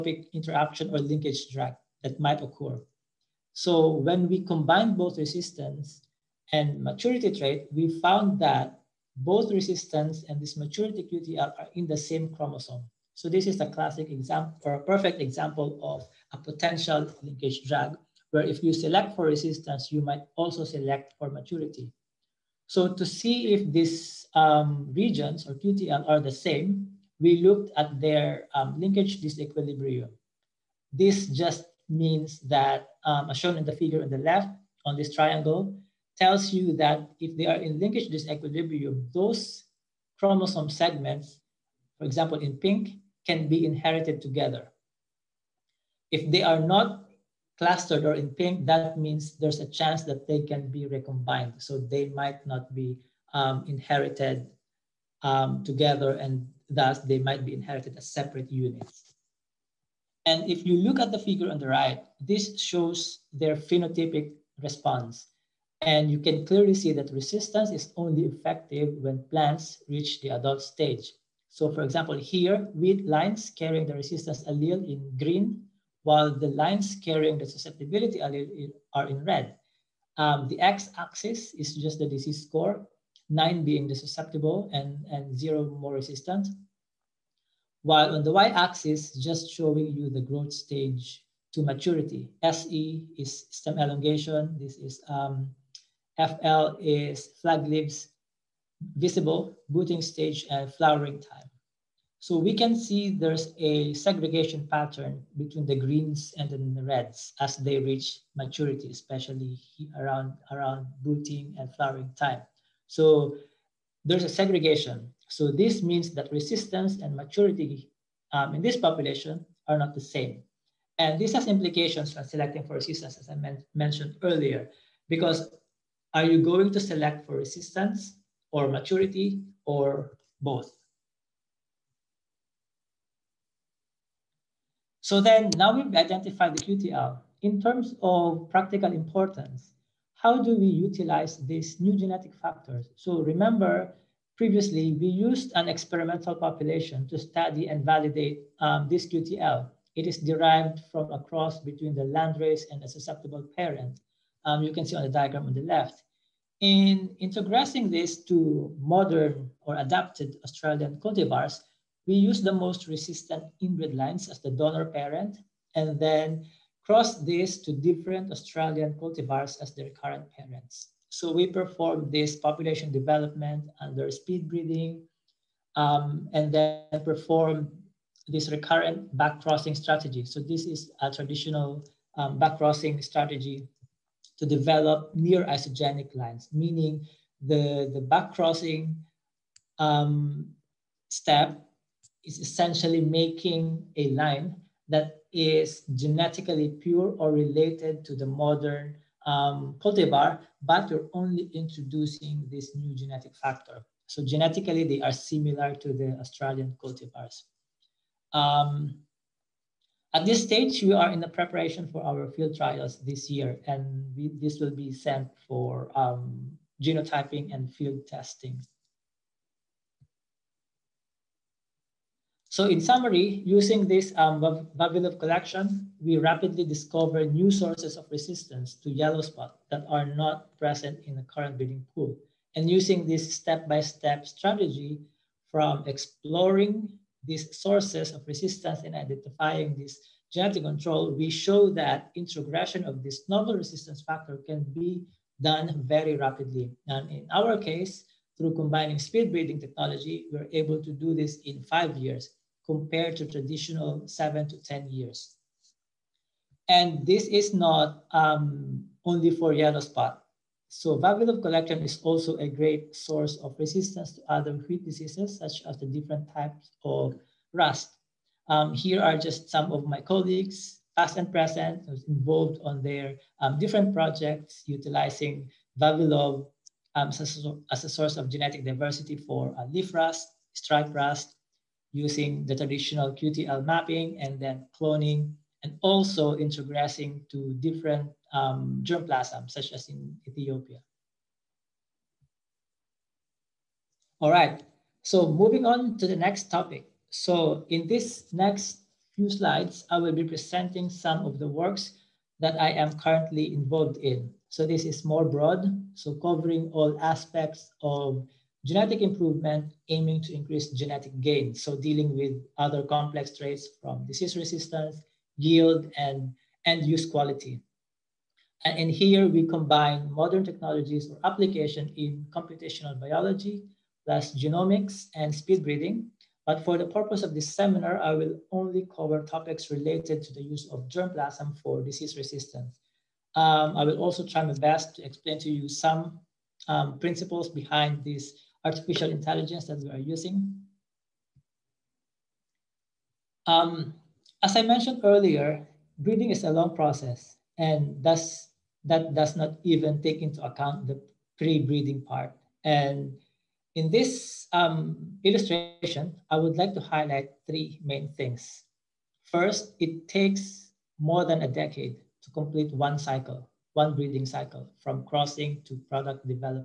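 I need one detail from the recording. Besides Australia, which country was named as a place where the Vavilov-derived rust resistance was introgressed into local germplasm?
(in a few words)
Ethiopia.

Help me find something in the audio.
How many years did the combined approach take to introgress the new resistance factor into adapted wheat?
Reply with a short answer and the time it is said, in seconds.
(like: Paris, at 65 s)
5, at 251 s.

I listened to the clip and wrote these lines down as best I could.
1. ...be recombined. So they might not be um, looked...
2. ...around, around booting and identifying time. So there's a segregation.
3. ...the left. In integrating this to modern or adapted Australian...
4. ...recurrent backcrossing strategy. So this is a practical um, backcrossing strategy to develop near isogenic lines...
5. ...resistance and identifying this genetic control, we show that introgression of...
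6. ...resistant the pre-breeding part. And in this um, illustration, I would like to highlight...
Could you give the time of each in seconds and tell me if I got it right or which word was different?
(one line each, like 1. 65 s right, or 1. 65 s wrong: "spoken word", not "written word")
1. 50 s wrong: "inherited", not "looked"
2. 109 s wrong: "flowering", not "identifying"
3. 155 s right
4. 178 s wrong: "traditional", not "practical"
5. 238 s right
6. 350 s wrong: "account", not "resistant".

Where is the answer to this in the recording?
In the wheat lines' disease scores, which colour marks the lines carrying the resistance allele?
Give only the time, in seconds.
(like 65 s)
75 s.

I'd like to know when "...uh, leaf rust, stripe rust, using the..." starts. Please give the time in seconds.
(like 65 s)
279 s.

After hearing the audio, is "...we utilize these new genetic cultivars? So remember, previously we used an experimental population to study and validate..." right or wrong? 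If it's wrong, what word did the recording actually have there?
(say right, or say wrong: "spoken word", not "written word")
wrong: "factors", not "cultivars".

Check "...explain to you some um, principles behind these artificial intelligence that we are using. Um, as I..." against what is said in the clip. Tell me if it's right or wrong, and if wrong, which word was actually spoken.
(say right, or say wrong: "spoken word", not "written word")
right.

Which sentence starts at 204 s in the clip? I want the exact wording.
So genetically, they are similar to the Australian cultivars.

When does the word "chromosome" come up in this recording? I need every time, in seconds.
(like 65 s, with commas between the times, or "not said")
12 s, 40 s.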